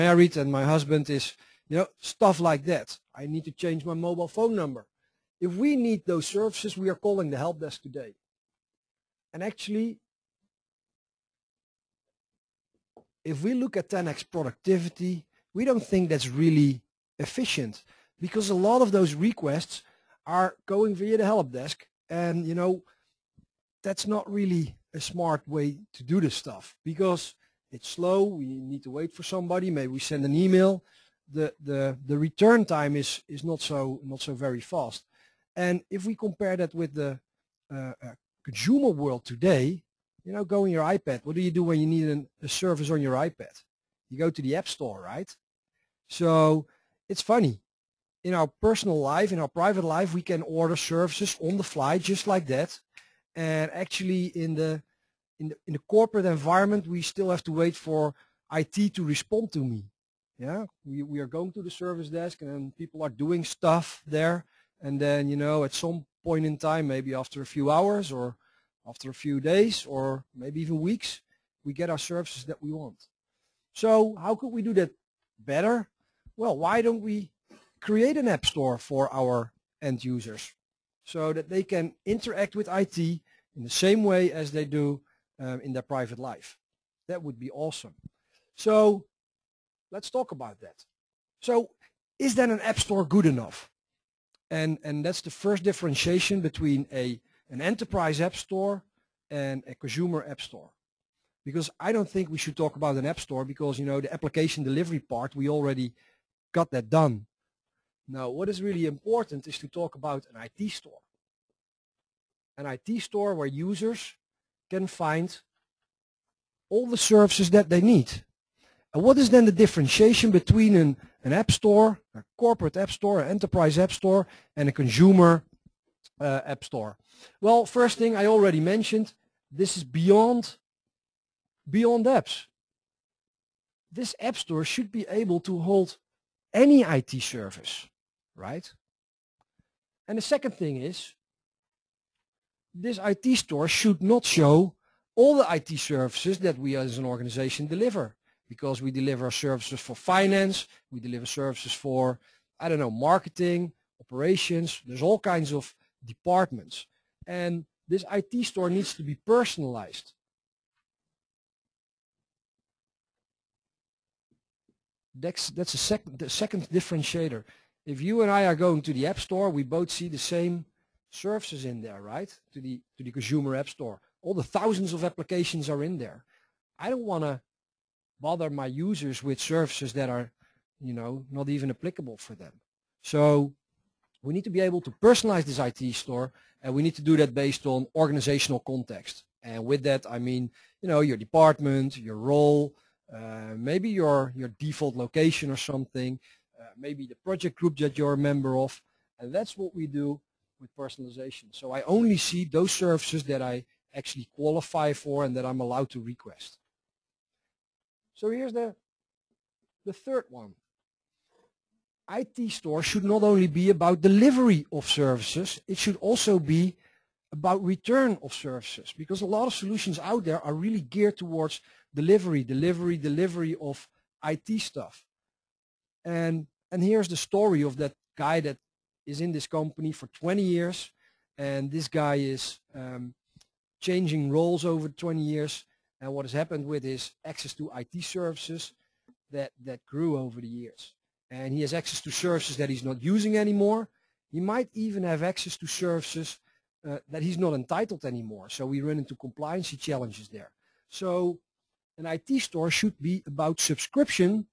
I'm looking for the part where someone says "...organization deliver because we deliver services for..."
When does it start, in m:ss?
2:27.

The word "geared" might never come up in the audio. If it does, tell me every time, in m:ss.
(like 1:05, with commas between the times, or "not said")
3:40.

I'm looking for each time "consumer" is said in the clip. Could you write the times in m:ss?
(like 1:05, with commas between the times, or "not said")
0:38, 1:39, 2:04, 2:53.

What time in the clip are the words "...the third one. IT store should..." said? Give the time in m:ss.
3:29.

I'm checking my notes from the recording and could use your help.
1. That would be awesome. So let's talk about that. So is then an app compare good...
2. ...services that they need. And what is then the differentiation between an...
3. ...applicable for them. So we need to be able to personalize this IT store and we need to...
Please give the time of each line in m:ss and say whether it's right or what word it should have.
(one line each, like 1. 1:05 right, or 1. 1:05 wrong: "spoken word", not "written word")
1. 1:27 wrong: "store", not "compare"
2. 1:56 right
3. 3:01 right.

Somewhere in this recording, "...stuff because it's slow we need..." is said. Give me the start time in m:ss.
0:26.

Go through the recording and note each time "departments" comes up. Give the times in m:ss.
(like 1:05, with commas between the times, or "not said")
2:36, 3:11.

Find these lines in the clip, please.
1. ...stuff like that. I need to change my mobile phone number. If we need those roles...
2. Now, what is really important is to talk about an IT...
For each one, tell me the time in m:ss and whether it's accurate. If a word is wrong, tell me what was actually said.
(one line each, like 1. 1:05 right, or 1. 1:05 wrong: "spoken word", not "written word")
1. 0:01 wrong: "services", not "roles"
2. 1:48 right.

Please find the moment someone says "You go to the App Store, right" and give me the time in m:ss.
0:44.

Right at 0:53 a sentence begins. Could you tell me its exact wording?
And actually in the in the, in the corporate environment, we still have to wait for IT to respond to me.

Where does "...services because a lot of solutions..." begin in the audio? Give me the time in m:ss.
3:38.